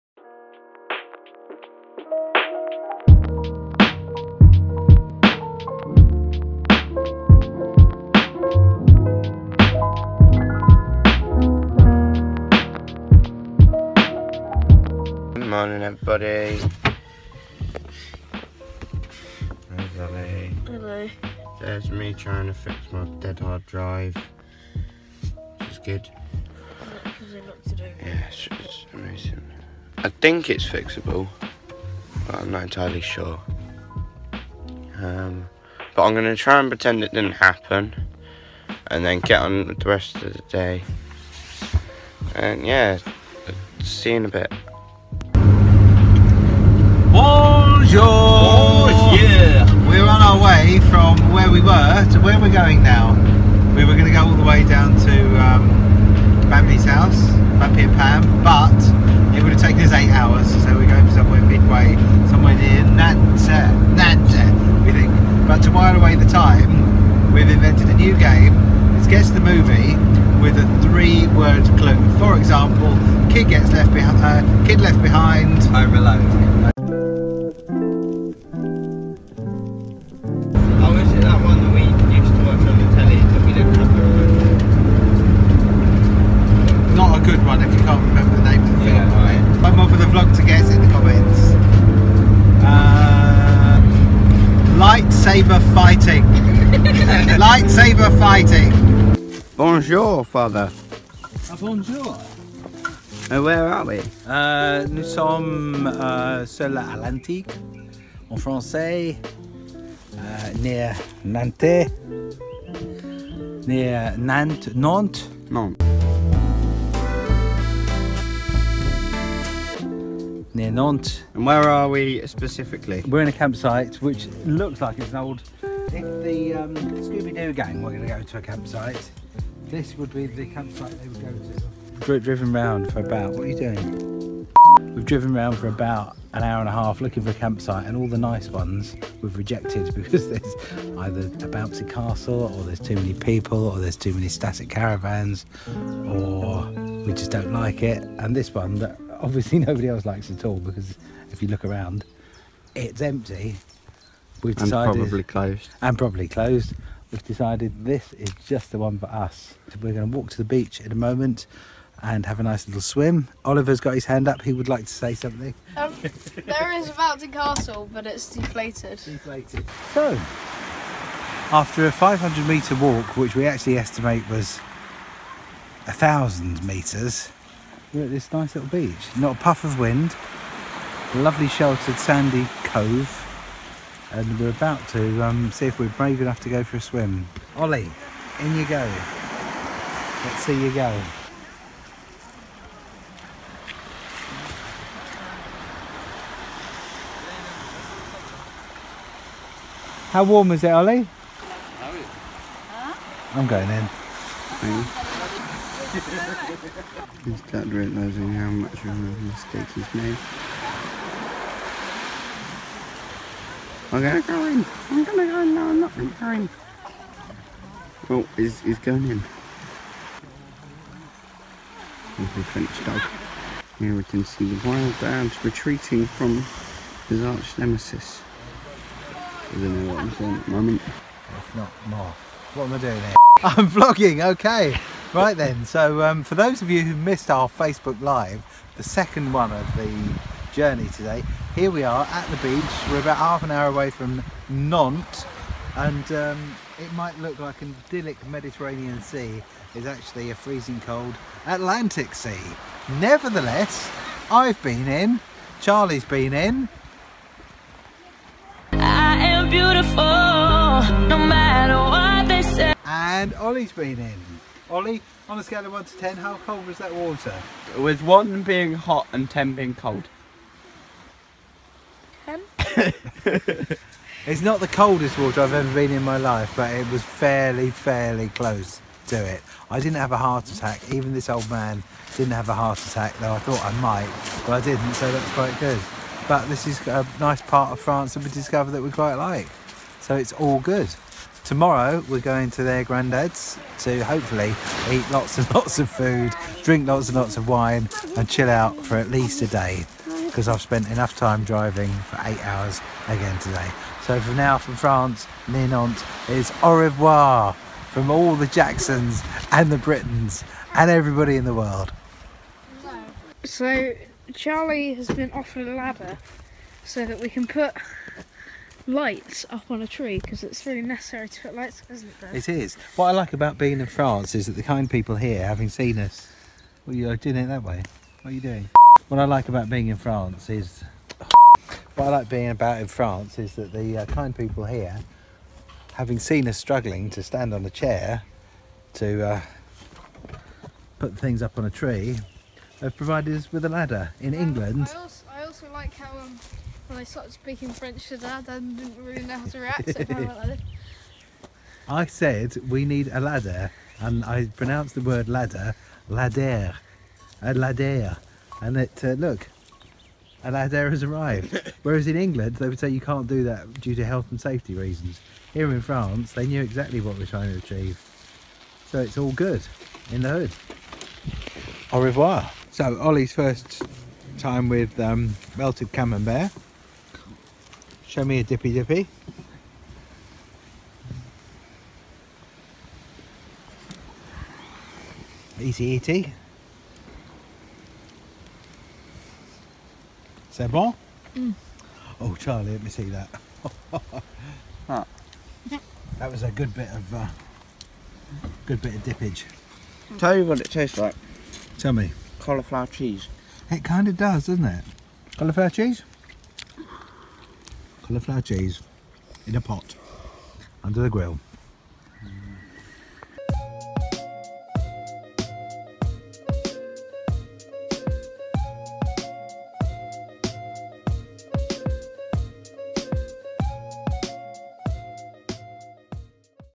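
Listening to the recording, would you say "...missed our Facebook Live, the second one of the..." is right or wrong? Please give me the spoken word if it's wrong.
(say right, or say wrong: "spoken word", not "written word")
right.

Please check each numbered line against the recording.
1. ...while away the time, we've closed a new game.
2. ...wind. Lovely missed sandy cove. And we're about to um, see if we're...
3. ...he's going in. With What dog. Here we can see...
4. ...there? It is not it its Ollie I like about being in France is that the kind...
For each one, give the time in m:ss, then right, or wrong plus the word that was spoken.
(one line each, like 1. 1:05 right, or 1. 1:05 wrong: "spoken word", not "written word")
1. 1:05 wrong: "invented", not "closed"
2. 2:59 wrong: "sheltered", not "missed"
3. 3:38 wrong: "French", not "What"
4. 5:22 wrong: "What", not "Ollie".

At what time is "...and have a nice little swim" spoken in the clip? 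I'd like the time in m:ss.
2:42.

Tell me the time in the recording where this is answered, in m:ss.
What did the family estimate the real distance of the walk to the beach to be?
2:55.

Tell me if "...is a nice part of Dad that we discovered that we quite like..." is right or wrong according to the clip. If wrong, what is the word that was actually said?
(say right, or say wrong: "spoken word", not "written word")
wrong: "France", not "Dad".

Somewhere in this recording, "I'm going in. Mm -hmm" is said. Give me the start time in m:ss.
3:23.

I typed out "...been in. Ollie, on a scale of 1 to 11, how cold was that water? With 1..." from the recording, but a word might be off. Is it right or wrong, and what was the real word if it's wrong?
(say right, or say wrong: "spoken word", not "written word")
wrong: "10", not "11".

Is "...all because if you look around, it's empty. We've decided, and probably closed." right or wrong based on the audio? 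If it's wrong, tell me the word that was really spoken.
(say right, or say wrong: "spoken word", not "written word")
right.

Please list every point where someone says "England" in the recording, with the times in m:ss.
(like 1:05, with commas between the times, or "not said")
5:44, 6:02.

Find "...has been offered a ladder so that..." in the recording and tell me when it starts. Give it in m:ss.
5:14.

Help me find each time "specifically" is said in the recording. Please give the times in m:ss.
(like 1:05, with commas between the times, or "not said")
2:02.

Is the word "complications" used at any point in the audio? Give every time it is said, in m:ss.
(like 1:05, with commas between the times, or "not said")
not said.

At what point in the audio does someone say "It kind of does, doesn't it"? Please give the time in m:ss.
6:43.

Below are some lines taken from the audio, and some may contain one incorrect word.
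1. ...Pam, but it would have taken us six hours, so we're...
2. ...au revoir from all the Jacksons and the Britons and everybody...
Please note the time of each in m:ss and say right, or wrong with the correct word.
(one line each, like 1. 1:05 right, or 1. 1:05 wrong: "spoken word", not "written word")
1. 0:57 wrong: "eight", not "six"
2. 5:06 right.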